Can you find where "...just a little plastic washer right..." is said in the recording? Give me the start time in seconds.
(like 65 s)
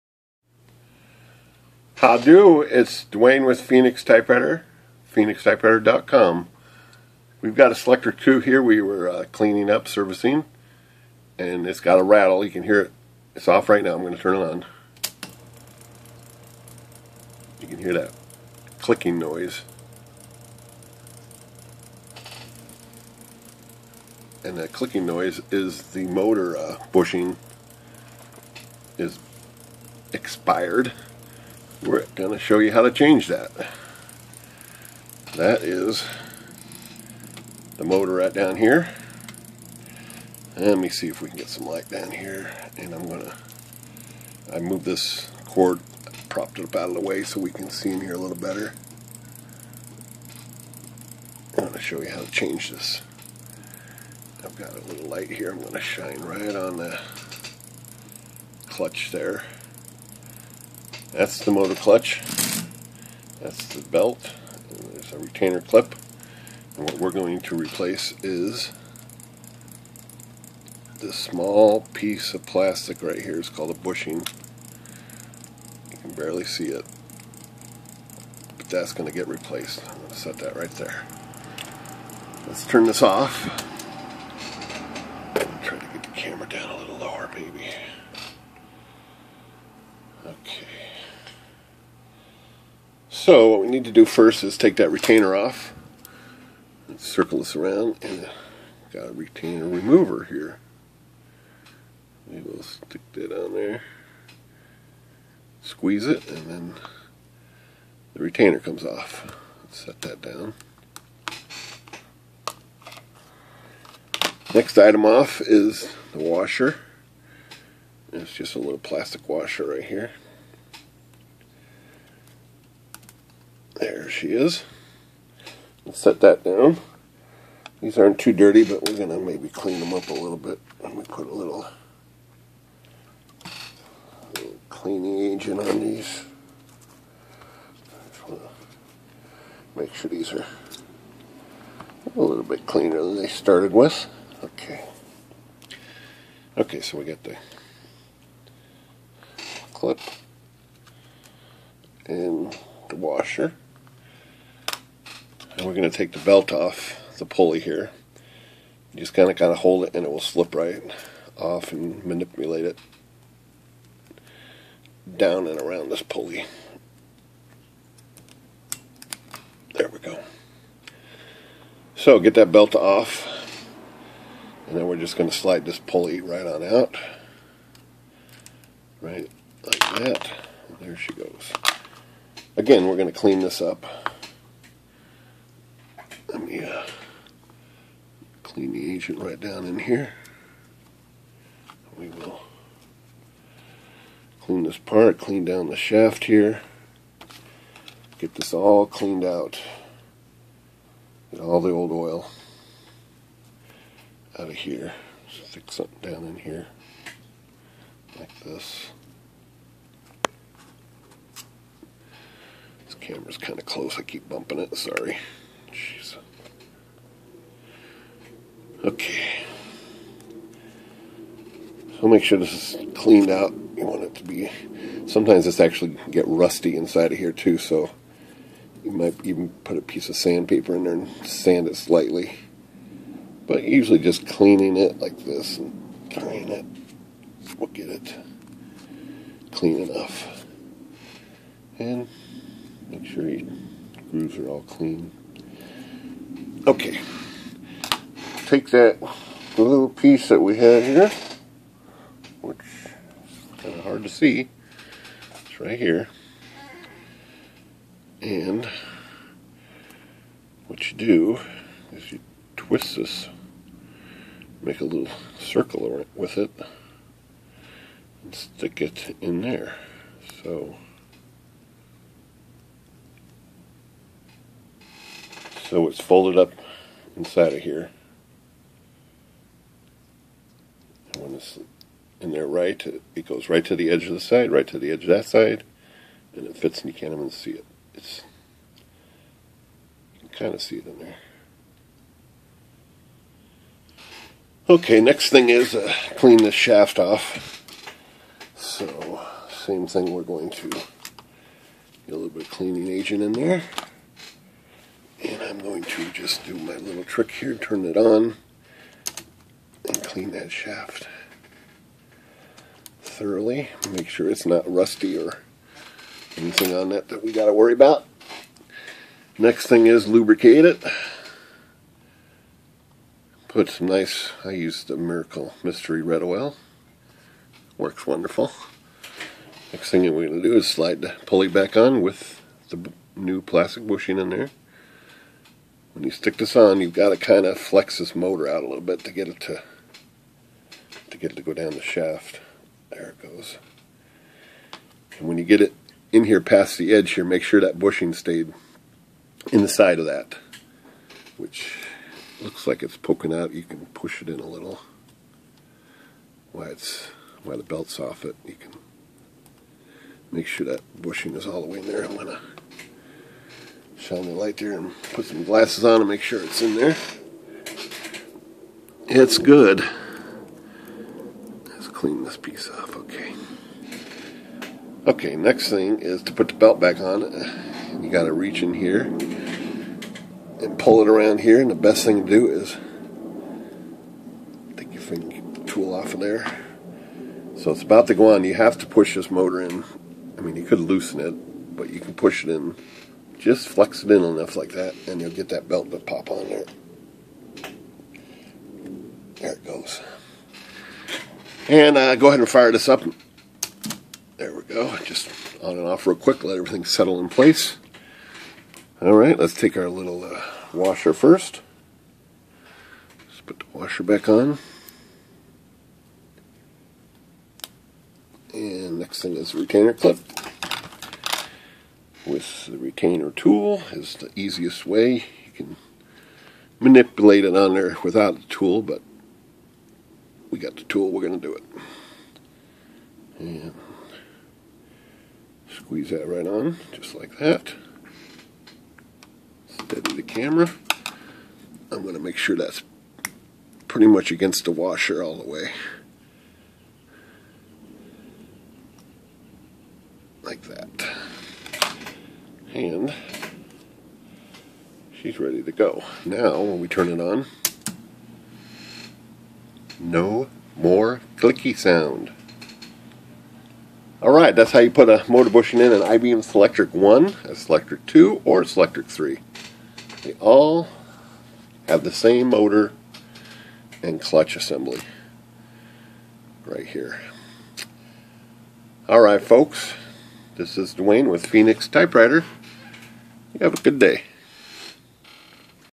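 118 s.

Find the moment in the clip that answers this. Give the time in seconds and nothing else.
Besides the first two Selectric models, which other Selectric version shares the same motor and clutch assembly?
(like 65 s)
468 s.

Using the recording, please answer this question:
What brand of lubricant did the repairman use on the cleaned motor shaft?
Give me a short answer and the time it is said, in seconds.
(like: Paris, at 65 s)
Miracle Mystery Red Oil, at 324 s.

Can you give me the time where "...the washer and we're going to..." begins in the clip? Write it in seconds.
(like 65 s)
152 s.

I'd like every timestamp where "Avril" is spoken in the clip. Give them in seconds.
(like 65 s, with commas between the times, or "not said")
not said.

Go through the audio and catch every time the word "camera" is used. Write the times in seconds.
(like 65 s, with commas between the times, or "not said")
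212 s, 440 s.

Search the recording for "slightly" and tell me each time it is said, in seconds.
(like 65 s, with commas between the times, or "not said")
231 s.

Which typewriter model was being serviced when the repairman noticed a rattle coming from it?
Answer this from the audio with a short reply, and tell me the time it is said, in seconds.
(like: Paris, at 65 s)
Selectric 2, at 7 s.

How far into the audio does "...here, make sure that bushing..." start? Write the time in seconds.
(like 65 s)
347 s.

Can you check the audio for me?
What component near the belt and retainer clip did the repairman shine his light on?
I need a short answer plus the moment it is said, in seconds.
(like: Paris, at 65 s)
motor clutch, at 61 s.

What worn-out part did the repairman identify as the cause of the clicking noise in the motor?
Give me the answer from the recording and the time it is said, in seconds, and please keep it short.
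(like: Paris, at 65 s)
motor bushing, at 26 s.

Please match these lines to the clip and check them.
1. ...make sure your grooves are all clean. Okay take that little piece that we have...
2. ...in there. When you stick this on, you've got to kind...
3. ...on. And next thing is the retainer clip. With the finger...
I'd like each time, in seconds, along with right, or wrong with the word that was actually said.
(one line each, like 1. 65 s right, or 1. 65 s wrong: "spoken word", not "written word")
1. 242 s right
2. 334 s right
3. 414 s wrong: "retainer", not "finger".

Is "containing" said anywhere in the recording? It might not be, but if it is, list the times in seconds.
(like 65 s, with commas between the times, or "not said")
not said.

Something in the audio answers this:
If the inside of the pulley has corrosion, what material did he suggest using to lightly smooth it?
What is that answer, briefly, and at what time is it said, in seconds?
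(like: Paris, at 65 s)
sandpaper, at 230 s.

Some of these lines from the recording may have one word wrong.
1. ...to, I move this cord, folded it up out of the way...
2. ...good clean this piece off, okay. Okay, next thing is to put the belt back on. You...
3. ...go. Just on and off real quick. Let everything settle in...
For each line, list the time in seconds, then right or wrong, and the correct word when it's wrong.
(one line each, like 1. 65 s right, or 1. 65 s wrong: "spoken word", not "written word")
1. 43 s wrong: "propped", not "folded"
2. 369 s right
3. 404 s right.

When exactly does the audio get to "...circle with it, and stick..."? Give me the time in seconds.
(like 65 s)
265 s.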